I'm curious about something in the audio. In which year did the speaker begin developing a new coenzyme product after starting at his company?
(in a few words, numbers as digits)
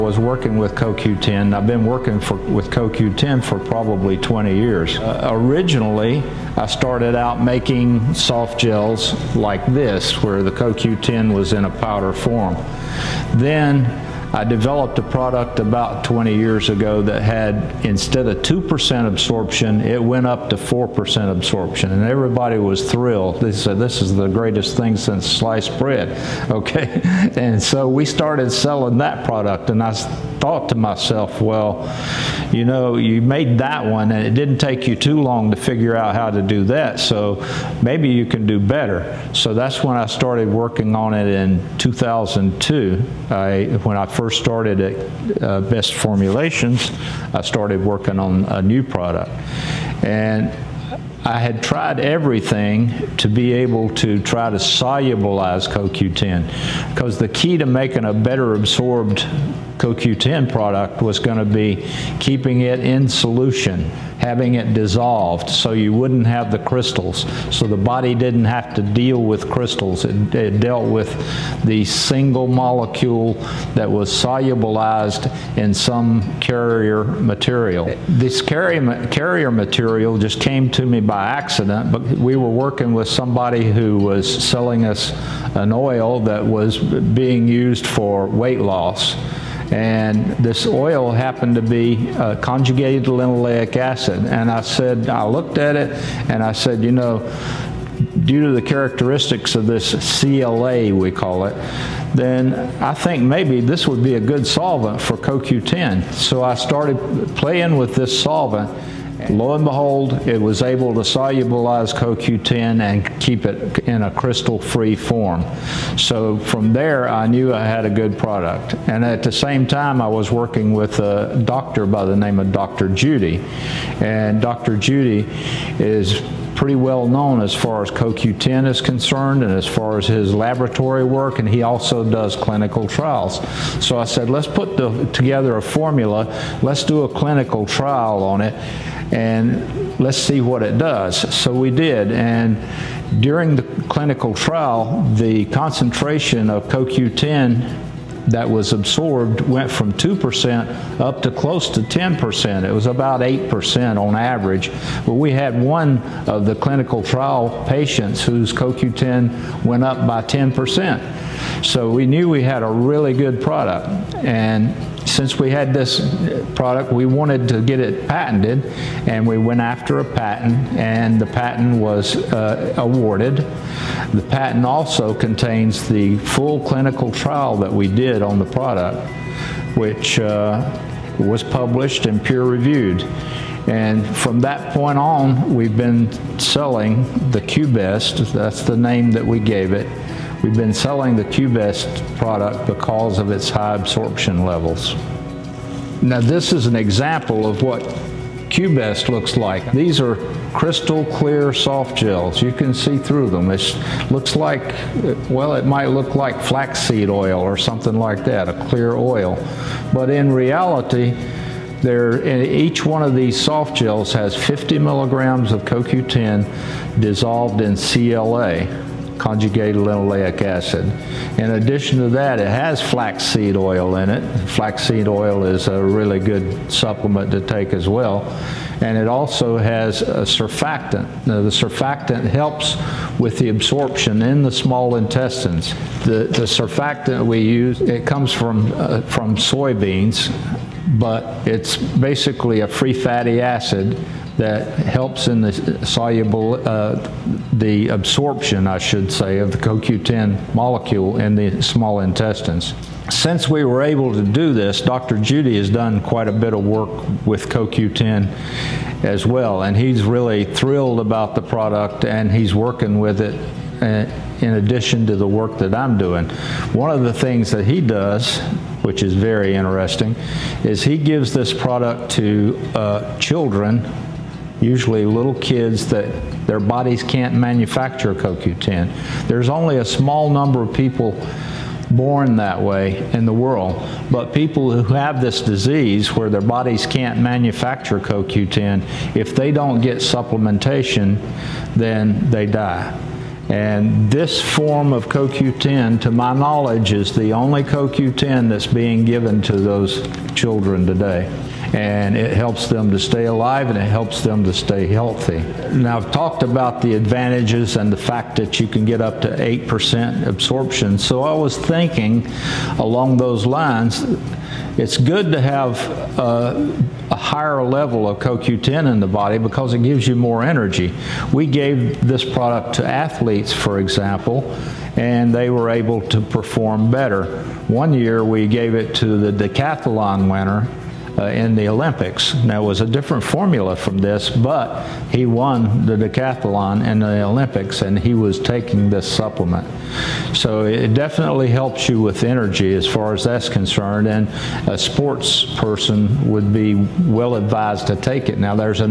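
2002.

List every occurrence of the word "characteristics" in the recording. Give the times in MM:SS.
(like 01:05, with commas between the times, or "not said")
01:38.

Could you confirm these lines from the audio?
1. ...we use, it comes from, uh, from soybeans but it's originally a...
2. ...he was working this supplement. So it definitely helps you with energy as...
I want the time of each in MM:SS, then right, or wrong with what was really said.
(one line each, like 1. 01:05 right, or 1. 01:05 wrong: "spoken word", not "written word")
1. 03:57 wrong: "basically", not "originally"
2. 05:37 wrong: "taking", not "working".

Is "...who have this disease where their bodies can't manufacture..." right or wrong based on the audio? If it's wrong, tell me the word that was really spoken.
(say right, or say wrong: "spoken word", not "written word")
right.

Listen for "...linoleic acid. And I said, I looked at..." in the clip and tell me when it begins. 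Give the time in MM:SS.
01:33.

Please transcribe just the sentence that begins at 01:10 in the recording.
It, it dealt with the single molecule that was solubilized in some carrier material.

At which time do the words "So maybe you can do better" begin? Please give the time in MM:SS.
00:36.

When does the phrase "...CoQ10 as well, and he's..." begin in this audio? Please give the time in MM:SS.
04:17.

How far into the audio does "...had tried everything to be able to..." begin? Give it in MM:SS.
00:51.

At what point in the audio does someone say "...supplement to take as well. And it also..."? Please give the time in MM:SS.
03:46.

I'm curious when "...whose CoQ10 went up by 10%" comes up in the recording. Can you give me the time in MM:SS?
02:38.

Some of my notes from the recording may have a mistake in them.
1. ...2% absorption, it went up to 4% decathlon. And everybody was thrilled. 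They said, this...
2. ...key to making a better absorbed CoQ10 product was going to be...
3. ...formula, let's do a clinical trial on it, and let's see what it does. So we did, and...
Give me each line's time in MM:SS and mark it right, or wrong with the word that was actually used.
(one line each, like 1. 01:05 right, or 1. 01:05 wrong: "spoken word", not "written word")
1. 00:18 wrong: "absorption", not "decathlon"
2. 00:57 right
3. 02:15 right.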